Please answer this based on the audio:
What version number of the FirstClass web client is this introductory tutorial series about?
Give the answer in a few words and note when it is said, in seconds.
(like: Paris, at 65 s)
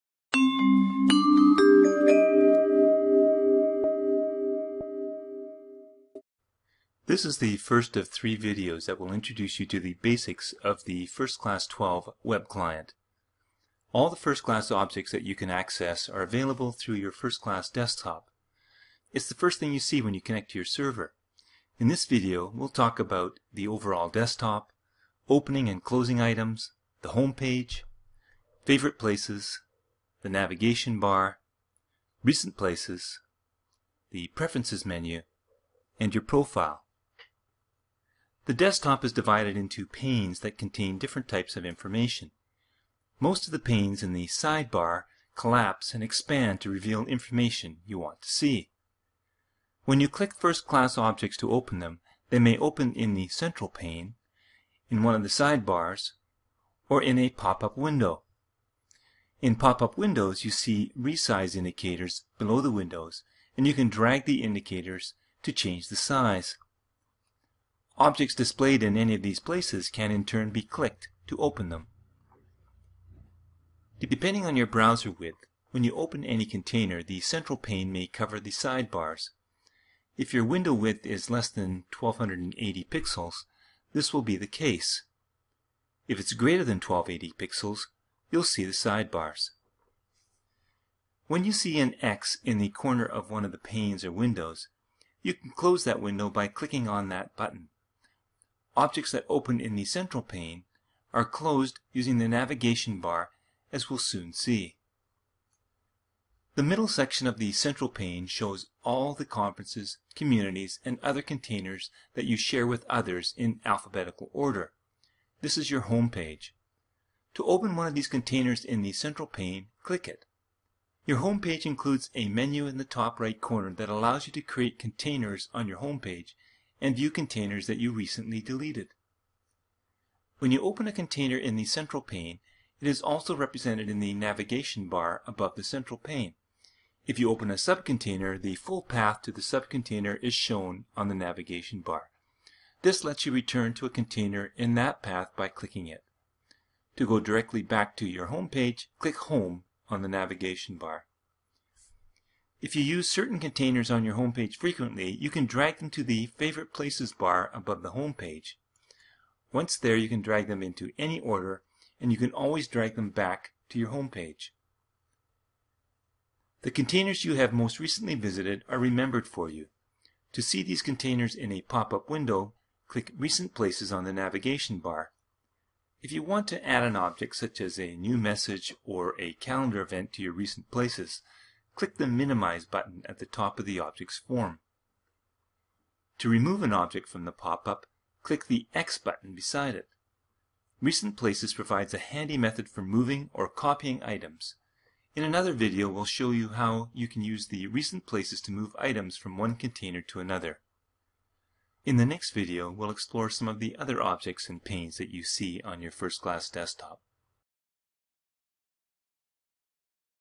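12, at 11 s.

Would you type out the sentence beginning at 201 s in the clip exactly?
In the next video, we'll explore some of the other objects and panes that you see on your FirstClass desktop.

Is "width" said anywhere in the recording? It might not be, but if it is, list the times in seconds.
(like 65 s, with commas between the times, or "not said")
75 s, 80 s.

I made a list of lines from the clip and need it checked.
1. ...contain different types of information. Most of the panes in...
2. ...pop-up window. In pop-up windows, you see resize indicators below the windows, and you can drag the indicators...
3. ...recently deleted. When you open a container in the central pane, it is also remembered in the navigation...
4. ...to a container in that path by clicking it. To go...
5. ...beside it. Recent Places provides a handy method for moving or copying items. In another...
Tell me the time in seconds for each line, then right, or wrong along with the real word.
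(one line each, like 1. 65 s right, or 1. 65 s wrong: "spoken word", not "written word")
1. 40 s right
2. 57 s right
3. 127 s wrong: "represented", not "remembered"
4. 143 s right
5. 189 s right.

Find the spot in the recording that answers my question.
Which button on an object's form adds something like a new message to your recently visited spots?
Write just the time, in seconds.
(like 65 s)
182 s.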